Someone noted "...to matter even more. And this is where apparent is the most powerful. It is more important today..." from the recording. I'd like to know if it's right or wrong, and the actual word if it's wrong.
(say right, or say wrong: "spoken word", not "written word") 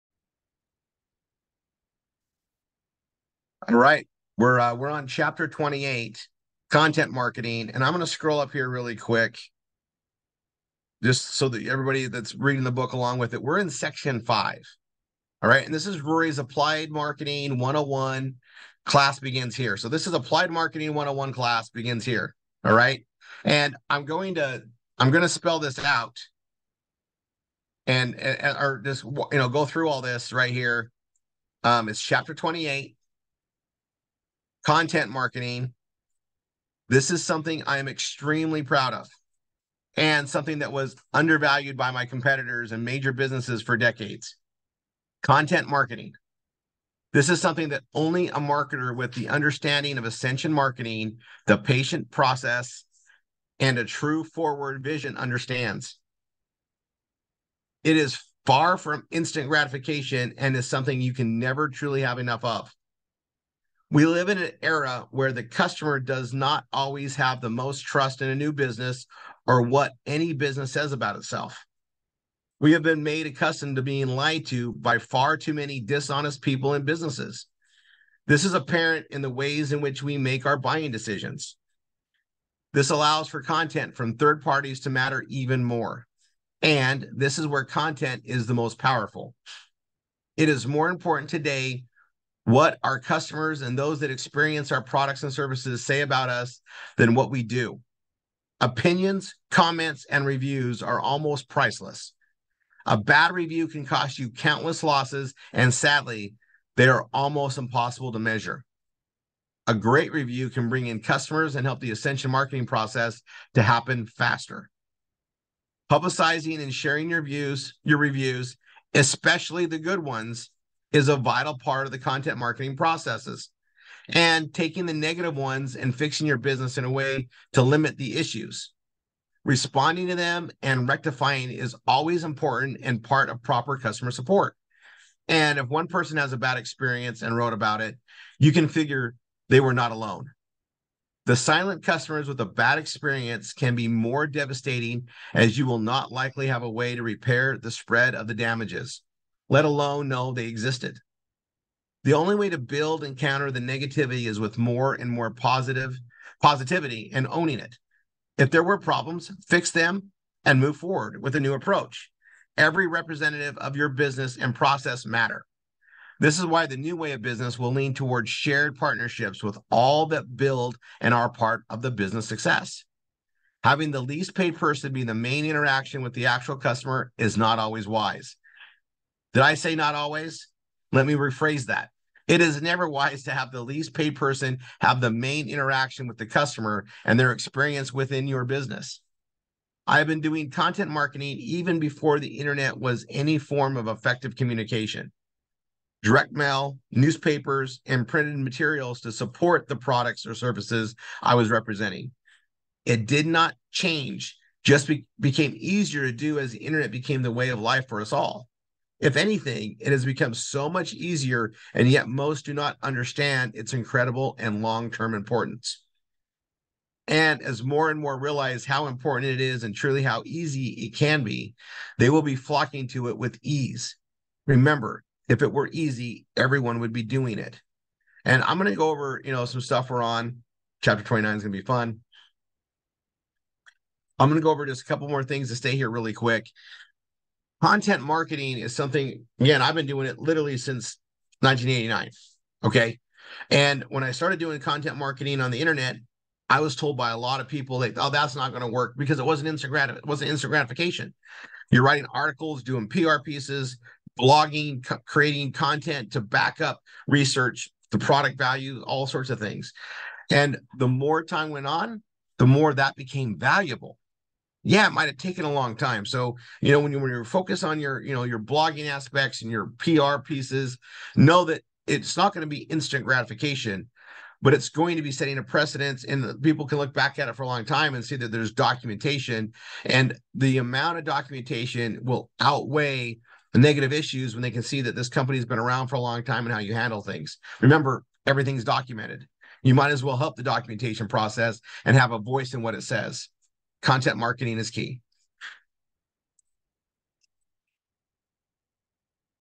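wrong: "content", not "apparent".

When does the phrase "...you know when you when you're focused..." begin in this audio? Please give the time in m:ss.
4:26.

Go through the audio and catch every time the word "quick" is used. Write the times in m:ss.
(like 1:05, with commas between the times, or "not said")
0:08, 3:56.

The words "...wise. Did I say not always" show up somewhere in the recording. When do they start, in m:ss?
2:57.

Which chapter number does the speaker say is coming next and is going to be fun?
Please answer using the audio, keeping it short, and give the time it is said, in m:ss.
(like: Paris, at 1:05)
29, at 3:50.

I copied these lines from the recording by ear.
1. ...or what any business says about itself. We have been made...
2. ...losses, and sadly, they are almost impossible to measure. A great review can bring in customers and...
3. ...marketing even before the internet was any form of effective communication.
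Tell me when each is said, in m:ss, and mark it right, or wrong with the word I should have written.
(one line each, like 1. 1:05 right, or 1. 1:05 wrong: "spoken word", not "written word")
1. 1:09 right
2. 1:44 right
3. 3:10 right.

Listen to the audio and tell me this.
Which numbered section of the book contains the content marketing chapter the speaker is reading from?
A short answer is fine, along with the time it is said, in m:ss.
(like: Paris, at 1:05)
Section five, at 0:13.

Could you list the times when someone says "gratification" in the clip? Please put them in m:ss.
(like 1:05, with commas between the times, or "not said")
0:59, 4:10, 4:33.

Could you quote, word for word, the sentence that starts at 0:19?
So this is Applied Marketing 101 class begins here.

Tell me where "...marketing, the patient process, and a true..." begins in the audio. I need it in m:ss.
0:50.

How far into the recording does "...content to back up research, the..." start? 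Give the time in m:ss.
4:15.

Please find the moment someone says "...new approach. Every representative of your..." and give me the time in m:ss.
2:41.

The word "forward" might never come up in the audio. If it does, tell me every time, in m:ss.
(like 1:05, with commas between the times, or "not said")
0:54, 2:40.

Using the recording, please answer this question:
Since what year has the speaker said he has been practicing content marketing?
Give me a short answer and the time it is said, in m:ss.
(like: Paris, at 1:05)
1989, at 4:01.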